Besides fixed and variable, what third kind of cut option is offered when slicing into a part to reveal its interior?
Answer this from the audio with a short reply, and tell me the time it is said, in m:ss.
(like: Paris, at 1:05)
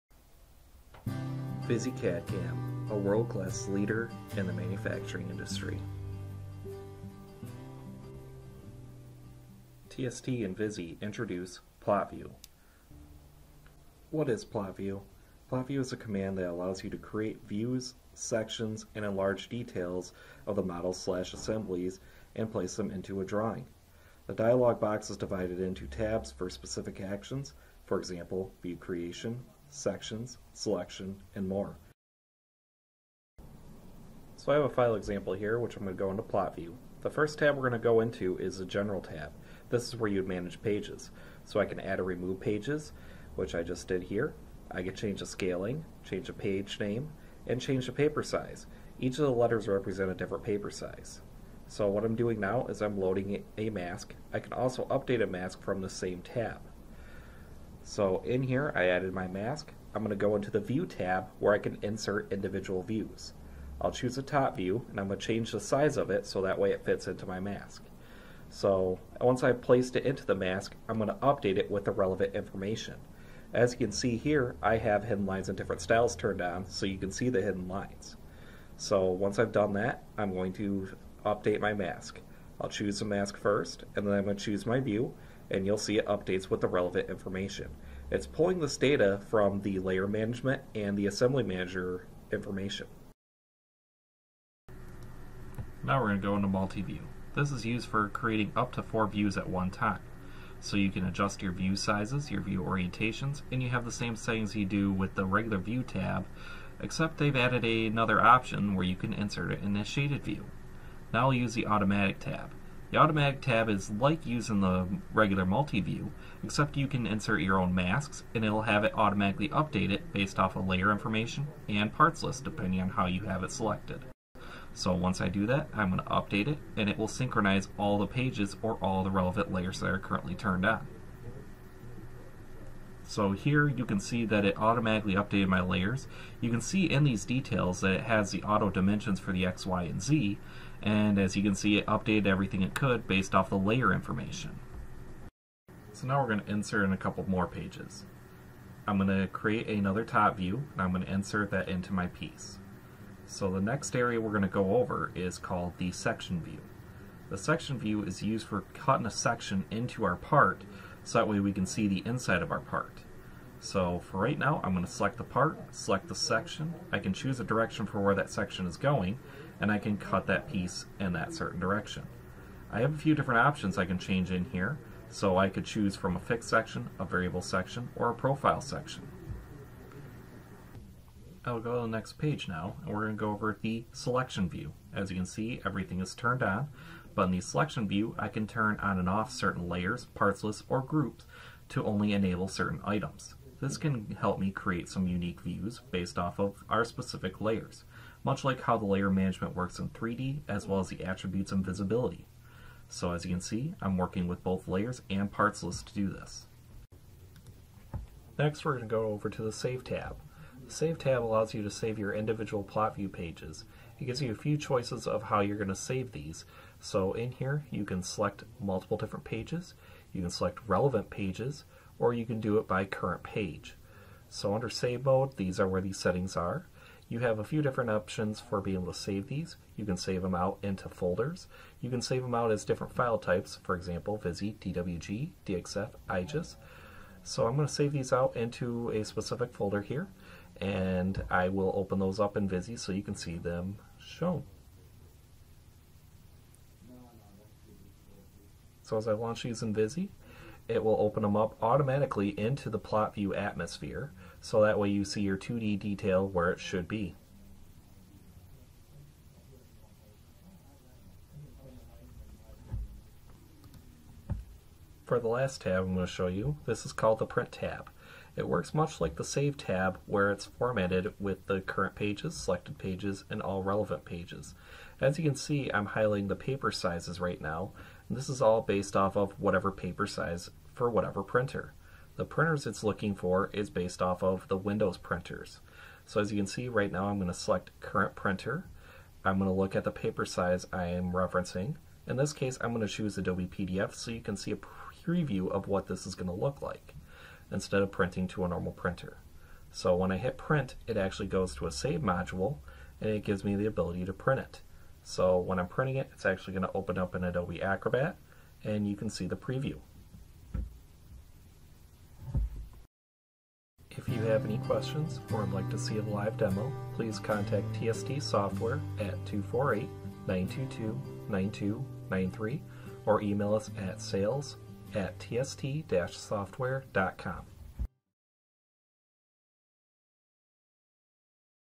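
profile section, at 2:58.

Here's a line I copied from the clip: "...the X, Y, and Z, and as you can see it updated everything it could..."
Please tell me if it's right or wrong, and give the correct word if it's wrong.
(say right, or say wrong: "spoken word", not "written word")
right.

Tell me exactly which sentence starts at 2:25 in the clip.
So now we're going to insert in a couple more pages.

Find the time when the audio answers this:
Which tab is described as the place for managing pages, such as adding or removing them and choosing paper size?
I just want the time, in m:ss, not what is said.
0:38.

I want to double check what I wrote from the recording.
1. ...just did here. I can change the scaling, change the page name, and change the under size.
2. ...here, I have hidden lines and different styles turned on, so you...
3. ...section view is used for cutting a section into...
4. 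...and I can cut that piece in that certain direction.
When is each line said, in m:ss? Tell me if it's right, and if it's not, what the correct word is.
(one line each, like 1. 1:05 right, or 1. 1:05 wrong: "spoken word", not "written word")
1. 0:43 wrong: "paper", not "under"
2. 1:14 right
3. 2:37 right
4. 2:49 right.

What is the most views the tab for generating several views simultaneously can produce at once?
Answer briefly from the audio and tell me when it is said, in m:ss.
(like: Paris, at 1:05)
4, at 1:38.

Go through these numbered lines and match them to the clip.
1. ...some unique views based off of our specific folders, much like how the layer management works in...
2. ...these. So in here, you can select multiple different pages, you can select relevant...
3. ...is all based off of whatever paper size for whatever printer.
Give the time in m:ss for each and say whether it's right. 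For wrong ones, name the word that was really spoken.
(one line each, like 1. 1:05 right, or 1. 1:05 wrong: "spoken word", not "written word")
1. 3:14 wrong: "layers", not "folders"
2. 3:36 right
3. 4:38 right.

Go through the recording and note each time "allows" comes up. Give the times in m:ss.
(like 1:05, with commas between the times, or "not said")
0:16, 3:31.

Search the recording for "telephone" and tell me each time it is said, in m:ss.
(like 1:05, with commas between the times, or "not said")
not said.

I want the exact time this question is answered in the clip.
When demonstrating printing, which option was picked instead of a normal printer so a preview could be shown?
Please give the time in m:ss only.
4:53.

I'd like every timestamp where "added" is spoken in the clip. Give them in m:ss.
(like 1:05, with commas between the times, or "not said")
0:58, 1:47.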